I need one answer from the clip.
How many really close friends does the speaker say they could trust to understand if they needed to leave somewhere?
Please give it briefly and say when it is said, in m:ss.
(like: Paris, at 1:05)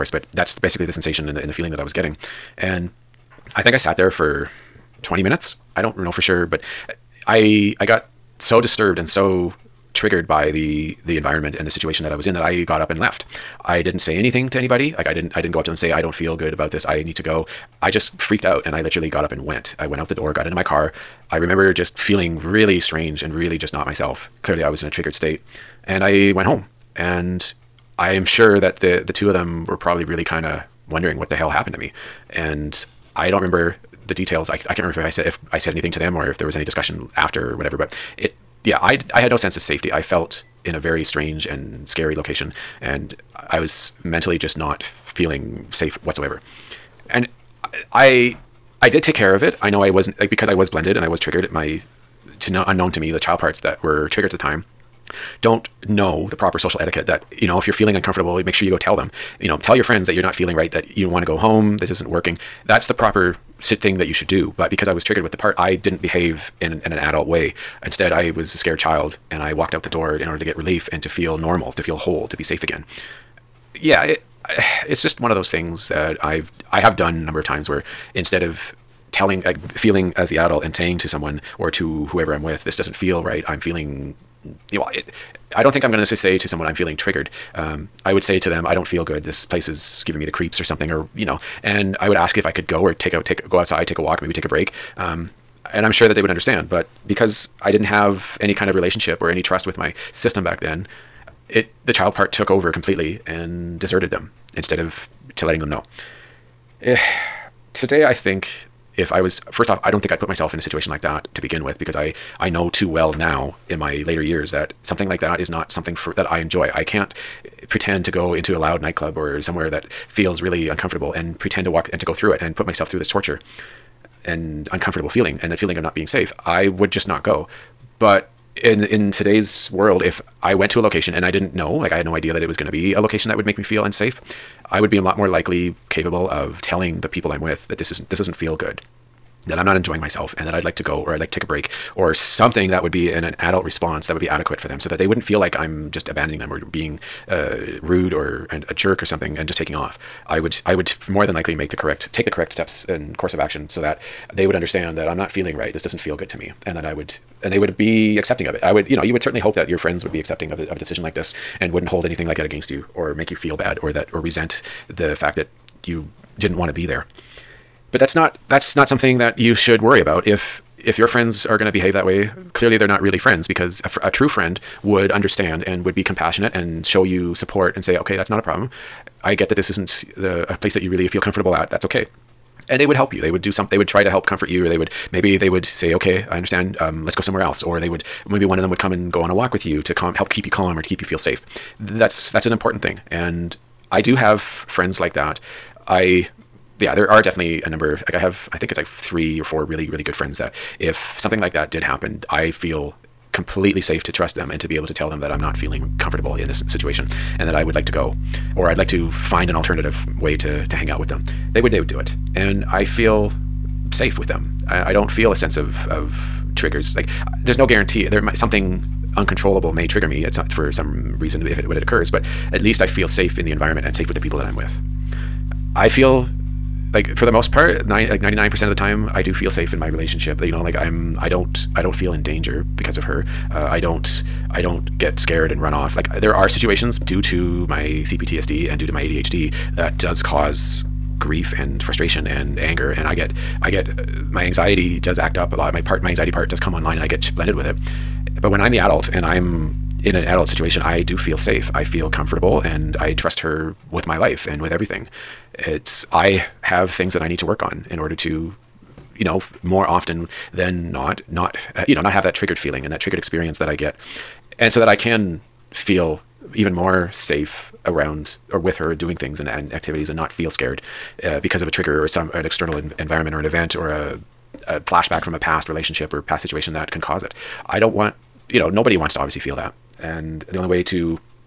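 3 or 4, at 3:18.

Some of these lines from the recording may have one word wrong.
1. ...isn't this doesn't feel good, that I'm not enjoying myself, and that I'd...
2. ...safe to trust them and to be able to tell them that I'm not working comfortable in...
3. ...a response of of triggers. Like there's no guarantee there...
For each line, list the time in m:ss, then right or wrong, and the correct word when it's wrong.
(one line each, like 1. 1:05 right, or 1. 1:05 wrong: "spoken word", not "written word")
1. 2:17 right
2. 3:23 wrong: "feeling", not "working"
3. 3:35 wrong: "sense", not "response".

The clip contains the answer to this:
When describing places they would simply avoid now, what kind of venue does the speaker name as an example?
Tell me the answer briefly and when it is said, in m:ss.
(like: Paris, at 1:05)
loud nightclub, at 1:58.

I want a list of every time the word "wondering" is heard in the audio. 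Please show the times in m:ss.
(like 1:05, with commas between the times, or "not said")
0:30.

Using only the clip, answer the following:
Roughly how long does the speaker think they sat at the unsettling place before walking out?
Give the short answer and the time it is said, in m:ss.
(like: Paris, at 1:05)
20 minutes, at 0:05.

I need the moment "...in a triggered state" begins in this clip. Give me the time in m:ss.
0:24.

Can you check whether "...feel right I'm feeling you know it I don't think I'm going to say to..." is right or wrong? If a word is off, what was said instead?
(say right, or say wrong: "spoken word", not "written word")
right.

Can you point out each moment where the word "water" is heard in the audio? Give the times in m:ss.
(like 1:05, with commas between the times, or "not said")
not said.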